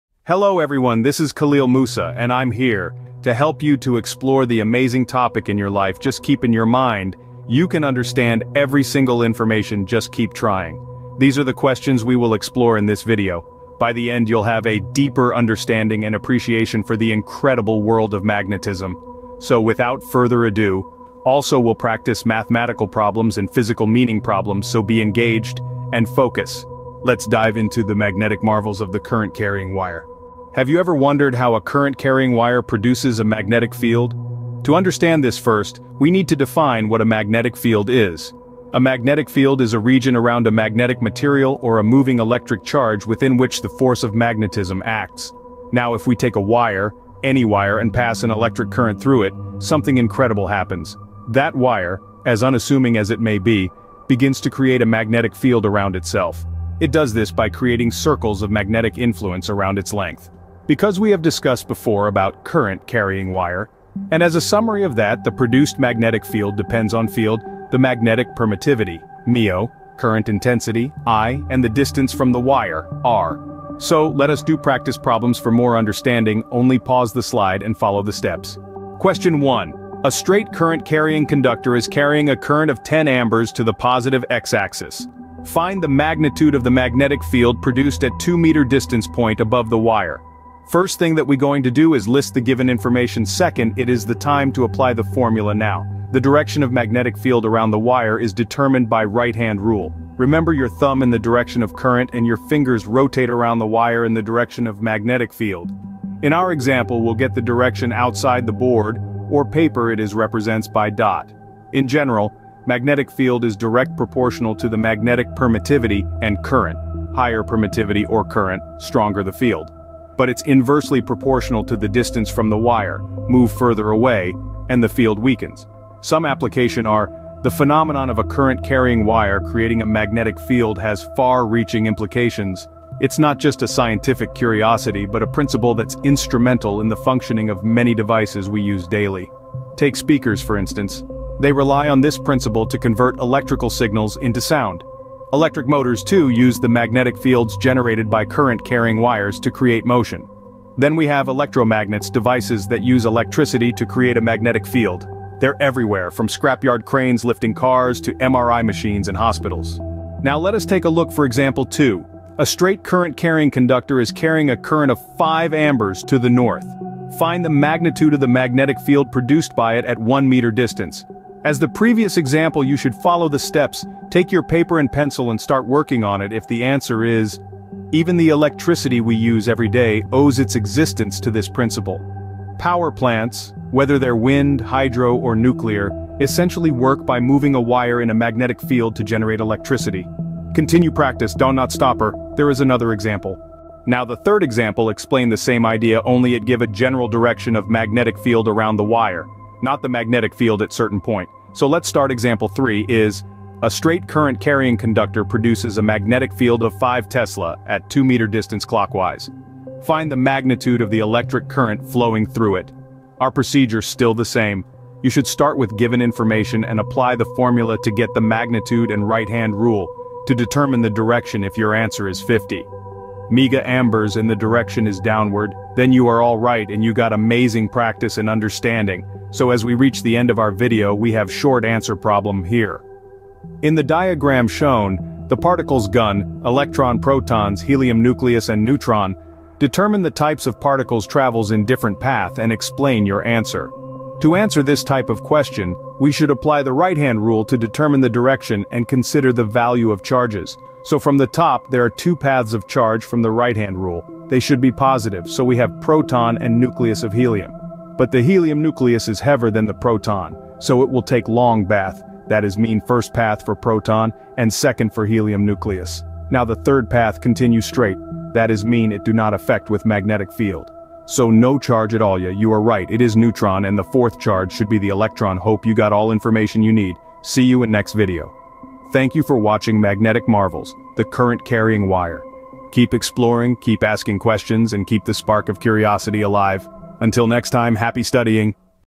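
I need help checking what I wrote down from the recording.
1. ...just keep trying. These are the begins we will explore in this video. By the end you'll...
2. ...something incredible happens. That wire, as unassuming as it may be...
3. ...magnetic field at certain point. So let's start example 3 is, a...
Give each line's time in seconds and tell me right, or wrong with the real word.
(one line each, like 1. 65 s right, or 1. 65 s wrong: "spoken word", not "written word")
1. 9 s wrong: "questions", not "begins"
2. 49 s right
3. 199 s right.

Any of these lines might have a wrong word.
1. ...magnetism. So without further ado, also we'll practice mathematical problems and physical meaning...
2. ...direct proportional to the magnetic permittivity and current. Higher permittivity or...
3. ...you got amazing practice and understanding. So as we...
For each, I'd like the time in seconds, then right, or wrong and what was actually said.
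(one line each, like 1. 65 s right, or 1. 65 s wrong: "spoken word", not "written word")
1. 18 s right
2. 113 s right
3. 226 s right.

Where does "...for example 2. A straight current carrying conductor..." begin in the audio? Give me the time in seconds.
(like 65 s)
161 s.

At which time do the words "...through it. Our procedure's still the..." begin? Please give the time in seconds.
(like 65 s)
212 s.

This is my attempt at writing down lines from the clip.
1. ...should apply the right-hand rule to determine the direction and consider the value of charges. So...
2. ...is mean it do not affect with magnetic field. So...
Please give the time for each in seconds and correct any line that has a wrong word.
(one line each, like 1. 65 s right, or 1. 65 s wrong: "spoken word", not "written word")
1. 246 s right
2. 268 s right.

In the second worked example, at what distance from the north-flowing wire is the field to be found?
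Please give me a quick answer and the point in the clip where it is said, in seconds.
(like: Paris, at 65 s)
1 meter, at 169 s.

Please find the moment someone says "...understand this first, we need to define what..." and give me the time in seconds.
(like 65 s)
34 s.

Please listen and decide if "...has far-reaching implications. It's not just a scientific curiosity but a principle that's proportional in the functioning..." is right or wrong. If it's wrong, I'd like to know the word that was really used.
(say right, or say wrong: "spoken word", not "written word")
wrong: "instrumental", not "proportional".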